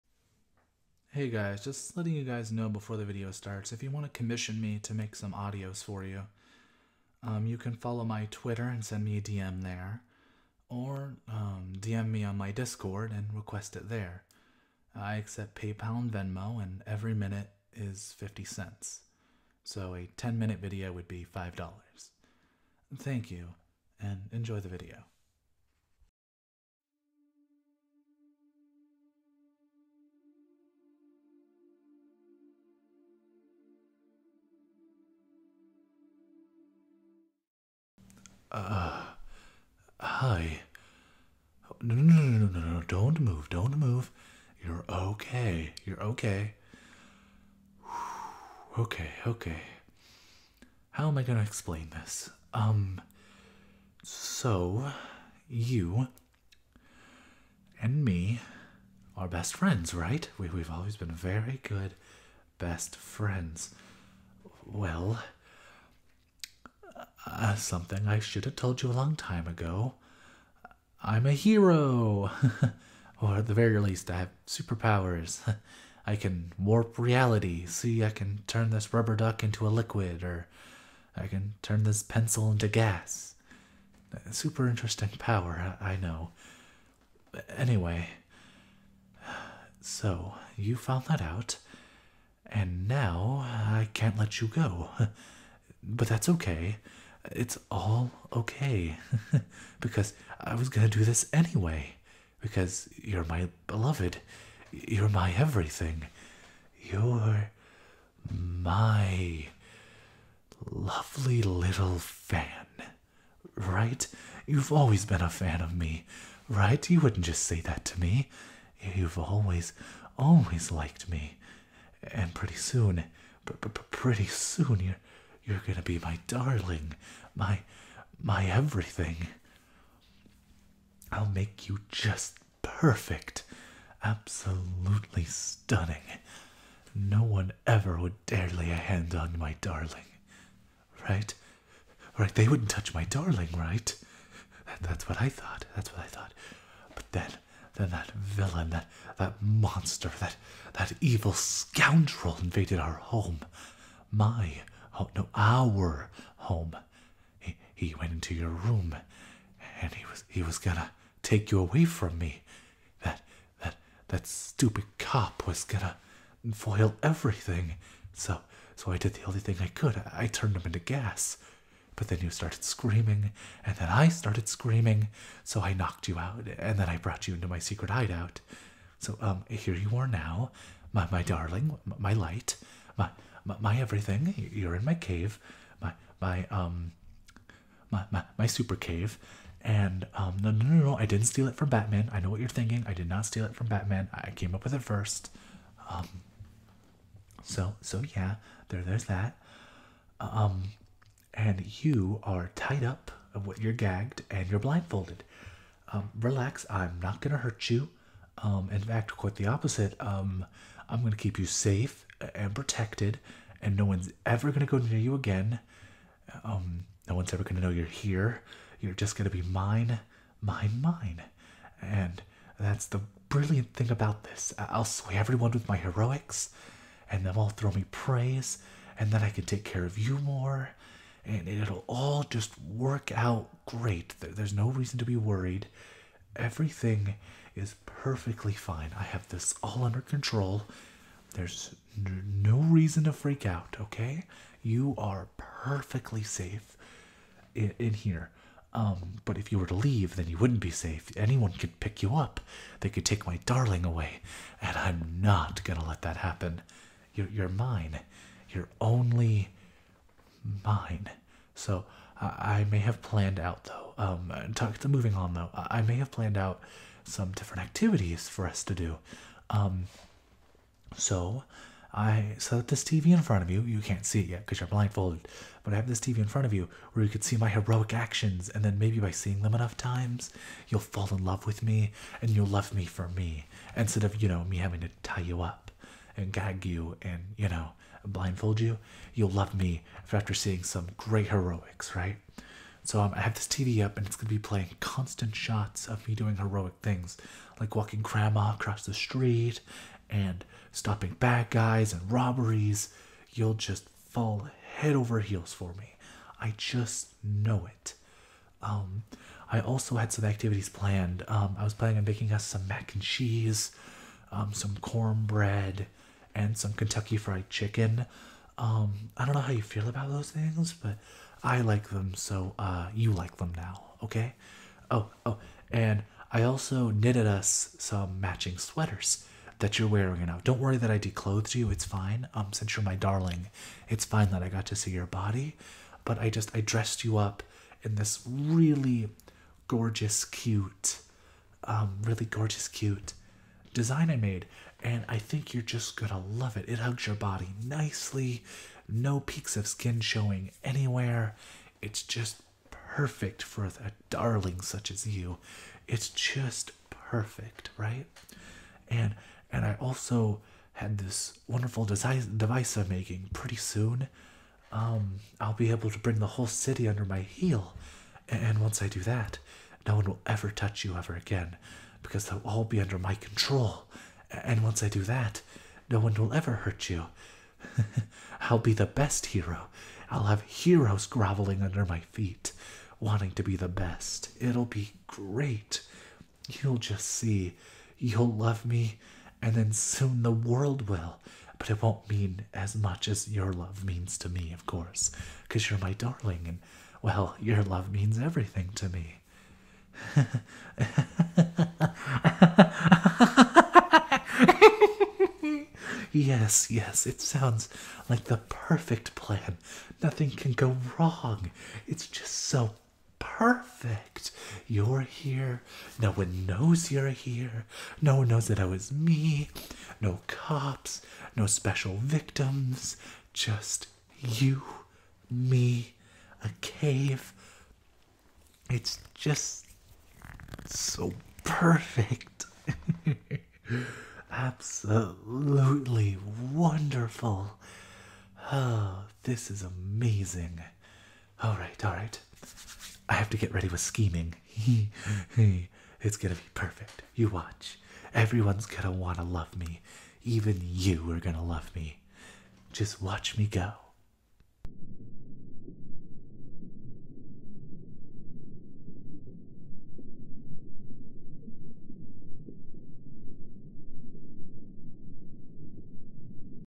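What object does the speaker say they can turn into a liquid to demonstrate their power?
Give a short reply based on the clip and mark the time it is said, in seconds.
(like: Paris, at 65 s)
rubber duck, at 78 s.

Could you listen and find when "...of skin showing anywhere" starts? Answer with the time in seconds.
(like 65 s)
349 s.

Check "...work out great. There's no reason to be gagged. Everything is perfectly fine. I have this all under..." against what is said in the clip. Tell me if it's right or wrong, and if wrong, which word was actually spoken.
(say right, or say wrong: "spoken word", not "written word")
wrong: "worried", not "gagged".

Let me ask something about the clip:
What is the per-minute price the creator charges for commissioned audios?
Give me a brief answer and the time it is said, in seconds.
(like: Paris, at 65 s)
50 cents, at 18 s.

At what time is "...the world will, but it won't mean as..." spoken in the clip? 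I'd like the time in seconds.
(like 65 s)
390 s.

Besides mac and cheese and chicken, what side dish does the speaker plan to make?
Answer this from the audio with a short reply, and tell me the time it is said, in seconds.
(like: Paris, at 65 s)
cornbread, at 314 s.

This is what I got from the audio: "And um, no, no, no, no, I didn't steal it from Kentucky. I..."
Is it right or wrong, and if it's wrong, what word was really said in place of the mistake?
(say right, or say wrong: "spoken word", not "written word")
wrong: "Batman", not "Kentucky".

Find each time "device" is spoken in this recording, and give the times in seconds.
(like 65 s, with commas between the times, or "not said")
361 s.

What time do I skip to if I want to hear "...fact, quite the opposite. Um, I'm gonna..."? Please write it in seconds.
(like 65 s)
208 s.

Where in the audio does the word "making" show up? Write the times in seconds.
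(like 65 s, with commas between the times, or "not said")
312 s, 362 s.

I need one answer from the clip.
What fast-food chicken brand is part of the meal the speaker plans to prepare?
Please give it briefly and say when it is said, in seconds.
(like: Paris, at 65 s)
Kentucky Fried Chicken, at 316 s.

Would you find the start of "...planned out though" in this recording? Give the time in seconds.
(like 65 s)
263 s.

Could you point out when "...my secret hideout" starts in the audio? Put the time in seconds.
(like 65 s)
177 s.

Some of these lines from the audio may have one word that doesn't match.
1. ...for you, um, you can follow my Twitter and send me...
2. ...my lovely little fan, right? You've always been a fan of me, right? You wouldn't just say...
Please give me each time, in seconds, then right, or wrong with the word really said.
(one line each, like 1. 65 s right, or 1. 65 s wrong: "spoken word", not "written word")
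1. 5 s right
2. 108 s right.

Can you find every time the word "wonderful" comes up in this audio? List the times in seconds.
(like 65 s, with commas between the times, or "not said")
361 s, 436 s.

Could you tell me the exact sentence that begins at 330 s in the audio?
Don't worry that I declothed you.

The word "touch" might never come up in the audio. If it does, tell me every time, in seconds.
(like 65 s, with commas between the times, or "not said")
142 s, 370 s.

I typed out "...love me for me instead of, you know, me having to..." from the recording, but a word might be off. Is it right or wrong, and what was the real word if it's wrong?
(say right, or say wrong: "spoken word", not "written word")
right.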